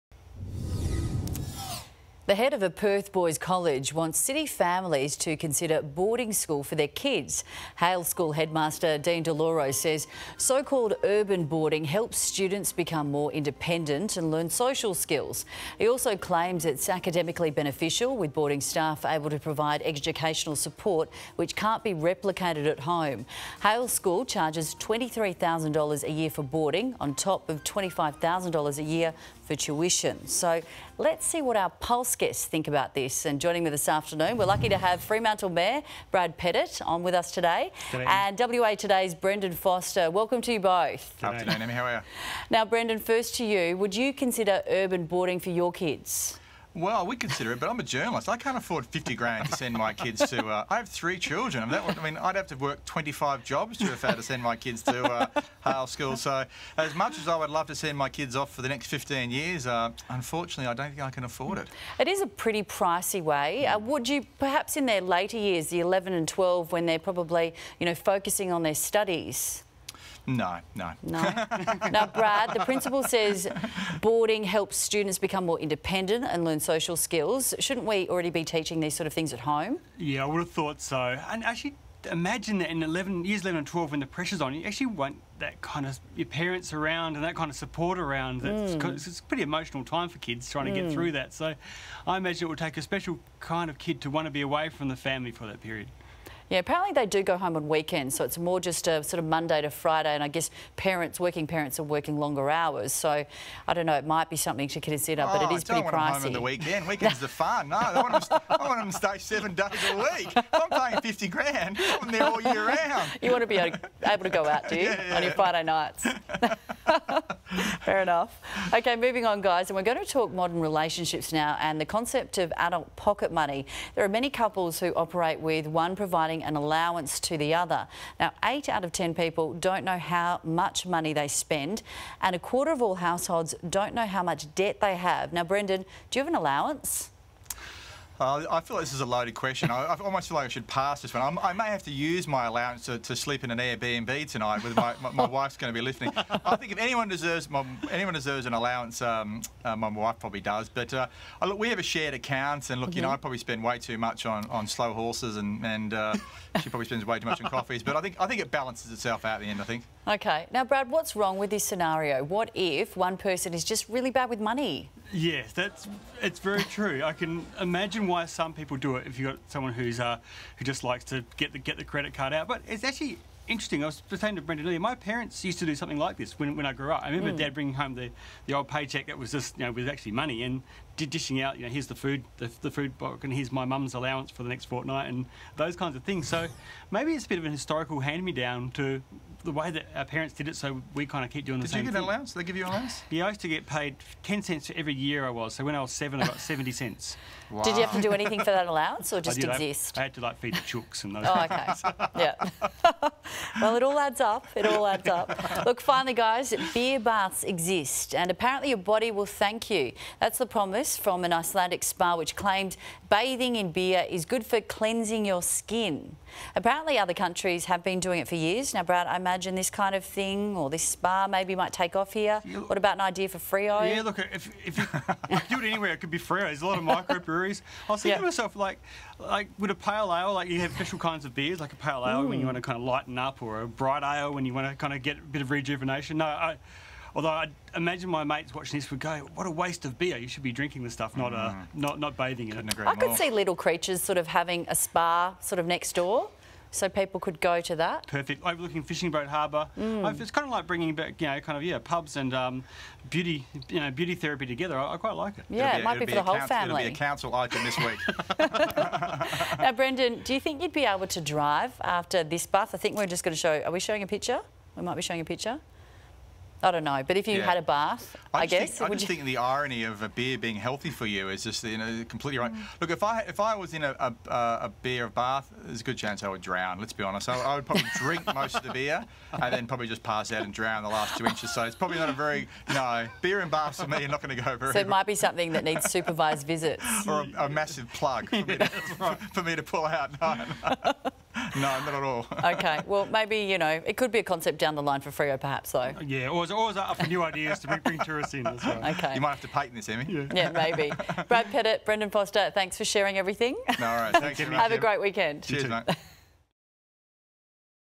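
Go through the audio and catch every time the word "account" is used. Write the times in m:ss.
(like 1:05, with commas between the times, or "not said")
2:32.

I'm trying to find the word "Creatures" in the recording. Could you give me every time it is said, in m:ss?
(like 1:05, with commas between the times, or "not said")
4:03.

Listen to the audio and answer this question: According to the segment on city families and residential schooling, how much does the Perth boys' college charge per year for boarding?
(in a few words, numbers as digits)
$23,000.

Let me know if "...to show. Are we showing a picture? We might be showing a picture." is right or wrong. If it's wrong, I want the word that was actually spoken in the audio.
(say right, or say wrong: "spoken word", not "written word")
right.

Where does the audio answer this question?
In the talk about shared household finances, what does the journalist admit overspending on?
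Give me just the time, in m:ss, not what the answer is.
2:34.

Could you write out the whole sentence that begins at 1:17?
Shouldn't we already be teaching these sort of things at home?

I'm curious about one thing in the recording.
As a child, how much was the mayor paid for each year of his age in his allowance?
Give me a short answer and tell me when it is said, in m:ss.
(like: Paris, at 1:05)
10 cents, at 3:14.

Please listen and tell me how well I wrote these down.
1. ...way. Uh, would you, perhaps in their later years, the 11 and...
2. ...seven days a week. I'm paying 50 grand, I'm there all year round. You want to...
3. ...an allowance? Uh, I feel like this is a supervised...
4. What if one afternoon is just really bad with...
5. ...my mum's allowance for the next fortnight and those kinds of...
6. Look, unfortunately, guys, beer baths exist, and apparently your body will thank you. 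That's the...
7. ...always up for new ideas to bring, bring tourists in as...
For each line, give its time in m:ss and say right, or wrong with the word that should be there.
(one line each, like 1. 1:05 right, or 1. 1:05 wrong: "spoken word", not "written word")
1. 1:03 right
2. 1:49 right
3. 2:16 wrong: "loaded", not "supervised"
4. 2:42 wrong: "person", not "afternoon"
5. 3:03 right
6. 3:25 wrong: "finally", not "unfortunately"
7. 4:56 right.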